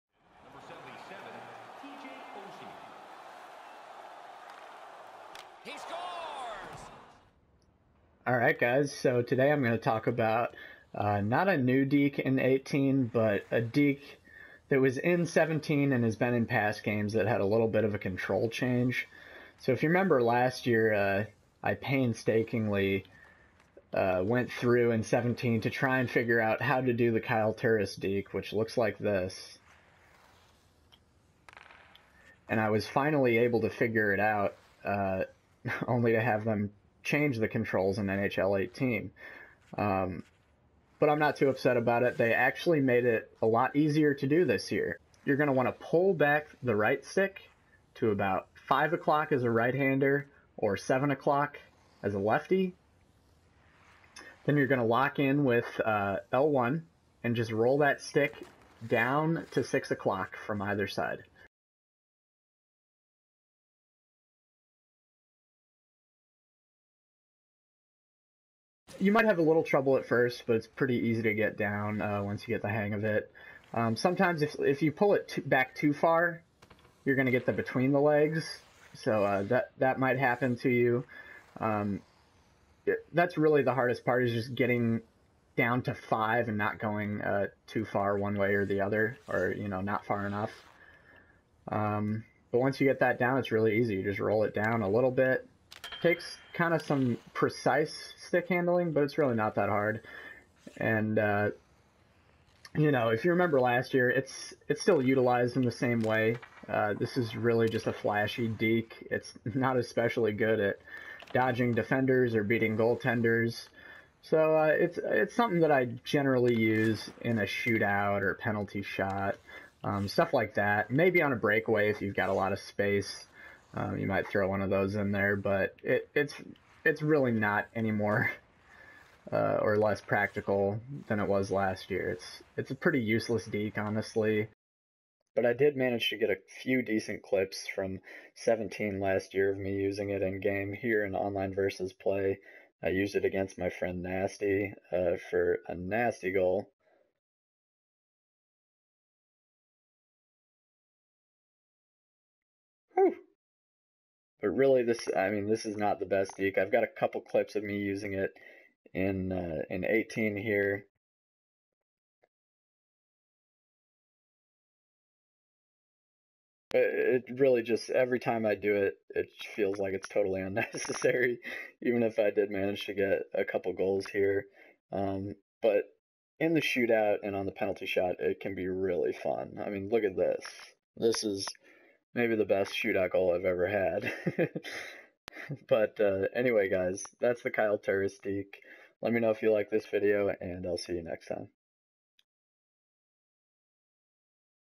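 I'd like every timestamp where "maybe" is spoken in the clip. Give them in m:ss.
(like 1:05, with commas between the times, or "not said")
2:00, 3:02.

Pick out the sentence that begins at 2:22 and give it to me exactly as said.
I used it against my friend Nasty uh, for a nasty goal.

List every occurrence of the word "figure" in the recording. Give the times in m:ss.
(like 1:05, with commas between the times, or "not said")
0:26, 0:33.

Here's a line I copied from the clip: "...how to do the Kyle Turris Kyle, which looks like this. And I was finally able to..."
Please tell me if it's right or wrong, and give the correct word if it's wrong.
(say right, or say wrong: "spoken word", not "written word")
wrong: "Deke", not "Kyle".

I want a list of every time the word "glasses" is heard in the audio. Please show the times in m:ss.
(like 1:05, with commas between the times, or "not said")
not said.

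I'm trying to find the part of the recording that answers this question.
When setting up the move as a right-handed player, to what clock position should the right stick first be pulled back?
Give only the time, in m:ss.
0:48.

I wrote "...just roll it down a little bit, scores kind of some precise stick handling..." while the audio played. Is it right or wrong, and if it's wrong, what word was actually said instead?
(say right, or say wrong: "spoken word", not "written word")
wrong: "takes", not "scores".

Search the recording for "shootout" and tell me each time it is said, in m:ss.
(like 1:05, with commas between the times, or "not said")
1:57, 2:56, 3:02.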